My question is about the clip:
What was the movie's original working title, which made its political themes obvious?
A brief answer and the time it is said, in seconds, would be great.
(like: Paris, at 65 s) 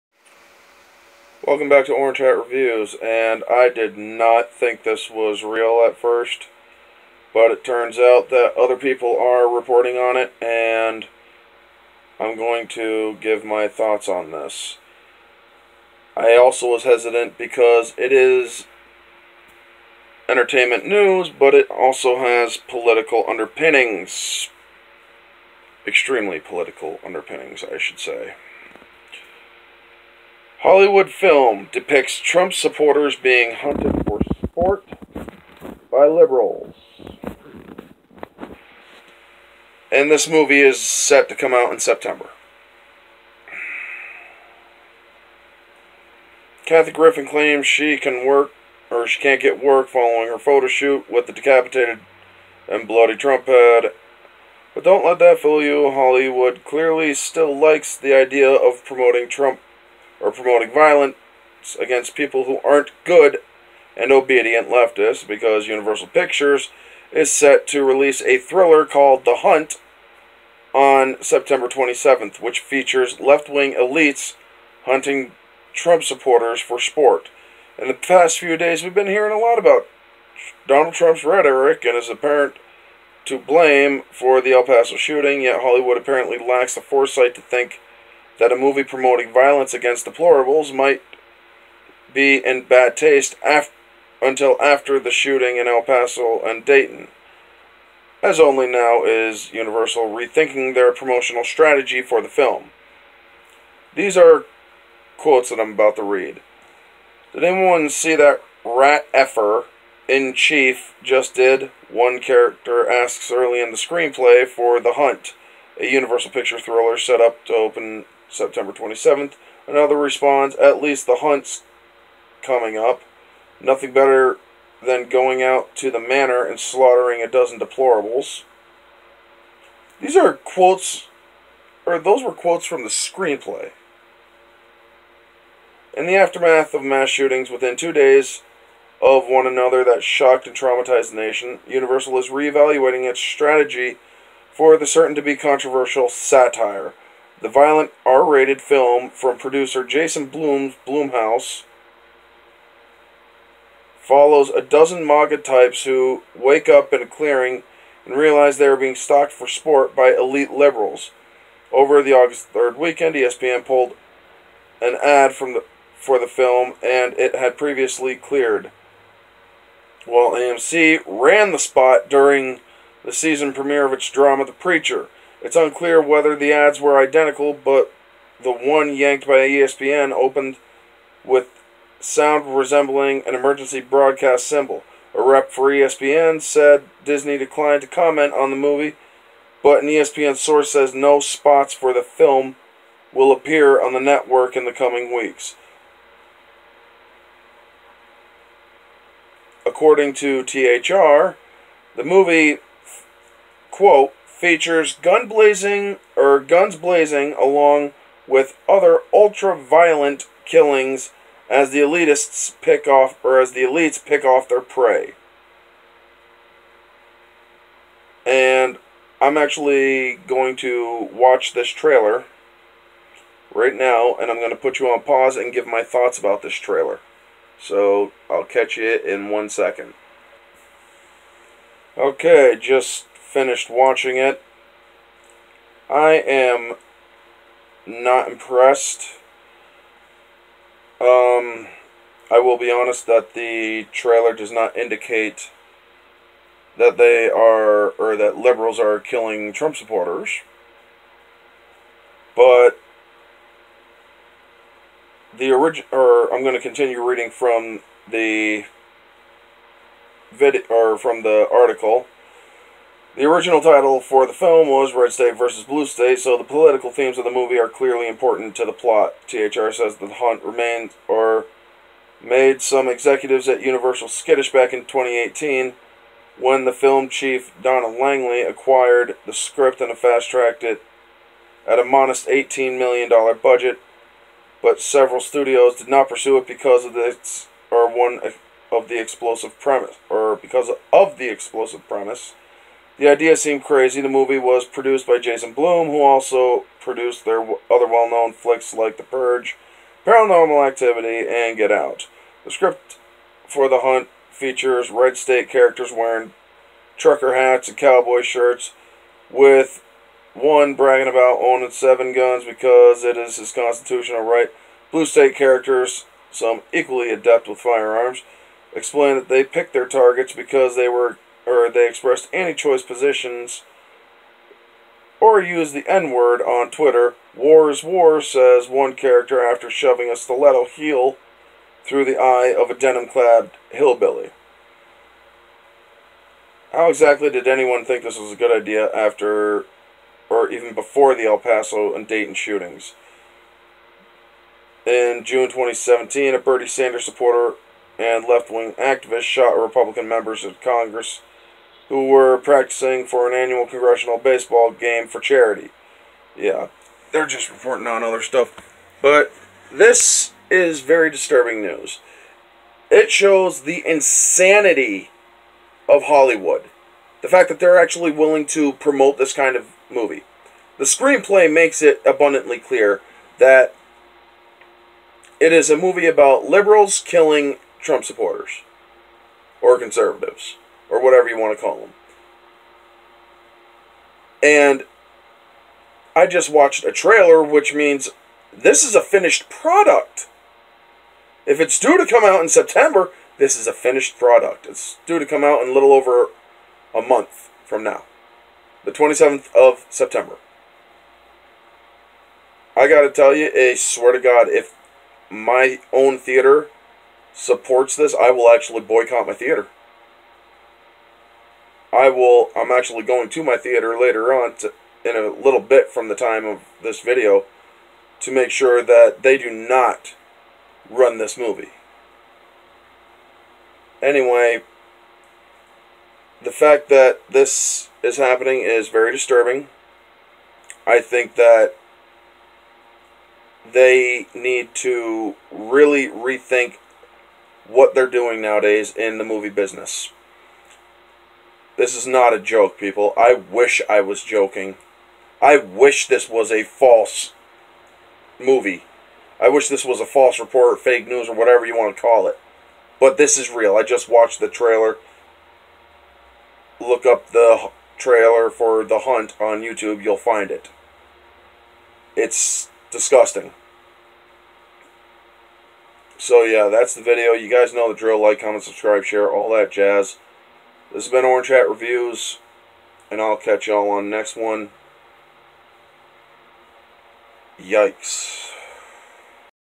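Red State versus Blue State, at 264 s.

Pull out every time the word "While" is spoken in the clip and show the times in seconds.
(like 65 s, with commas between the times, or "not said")
170 s.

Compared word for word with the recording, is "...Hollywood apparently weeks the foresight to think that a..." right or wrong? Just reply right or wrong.
wrong.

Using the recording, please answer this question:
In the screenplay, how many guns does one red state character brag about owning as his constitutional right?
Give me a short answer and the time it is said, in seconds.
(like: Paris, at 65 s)
7, at 311 s.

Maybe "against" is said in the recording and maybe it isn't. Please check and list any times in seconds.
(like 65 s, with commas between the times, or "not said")
61 s, 89 s.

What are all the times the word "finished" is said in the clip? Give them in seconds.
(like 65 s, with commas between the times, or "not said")
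233 s, 389 s, 393 s.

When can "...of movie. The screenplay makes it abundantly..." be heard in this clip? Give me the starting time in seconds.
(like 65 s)
369 s.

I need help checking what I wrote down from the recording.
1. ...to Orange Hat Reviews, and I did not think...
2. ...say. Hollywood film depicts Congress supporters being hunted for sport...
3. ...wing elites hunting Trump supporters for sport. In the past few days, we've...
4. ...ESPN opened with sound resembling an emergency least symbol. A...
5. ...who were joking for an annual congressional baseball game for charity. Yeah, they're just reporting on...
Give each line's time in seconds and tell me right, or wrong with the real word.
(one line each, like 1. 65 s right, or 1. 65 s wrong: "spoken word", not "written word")
1. 1 s right
2. 27 s wrong: "Trump", not "Congress"
3. 73 s right
4. 179 s wrong: "broadcast", not "least"
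5. 351 s wrong: "practicing", not "joking".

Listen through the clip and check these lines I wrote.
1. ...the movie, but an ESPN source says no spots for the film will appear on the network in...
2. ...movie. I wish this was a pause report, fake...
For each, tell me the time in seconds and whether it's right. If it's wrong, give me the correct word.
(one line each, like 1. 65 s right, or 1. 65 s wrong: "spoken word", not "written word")
1. 188 s right
2. 448 s wrong: "false", not "pause".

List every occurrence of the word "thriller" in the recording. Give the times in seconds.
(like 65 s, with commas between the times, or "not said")
68 s, 116 s.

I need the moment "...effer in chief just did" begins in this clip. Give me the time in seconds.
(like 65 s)
109 s.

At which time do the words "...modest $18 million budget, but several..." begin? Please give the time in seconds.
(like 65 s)
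281 s.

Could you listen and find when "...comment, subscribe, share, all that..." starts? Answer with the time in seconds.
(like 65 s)
468 s.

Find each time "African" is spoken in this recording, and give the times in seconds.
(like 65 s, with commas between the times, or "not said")
not said.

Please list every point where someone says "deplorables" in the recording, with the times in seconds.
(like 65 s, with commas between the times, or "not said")
127 s.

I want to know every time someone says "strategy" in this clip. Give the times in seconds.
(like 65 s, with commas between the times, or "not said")
101 s, 143 s.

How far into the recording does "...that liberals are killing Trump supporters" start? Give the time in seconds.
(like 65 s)
248 s.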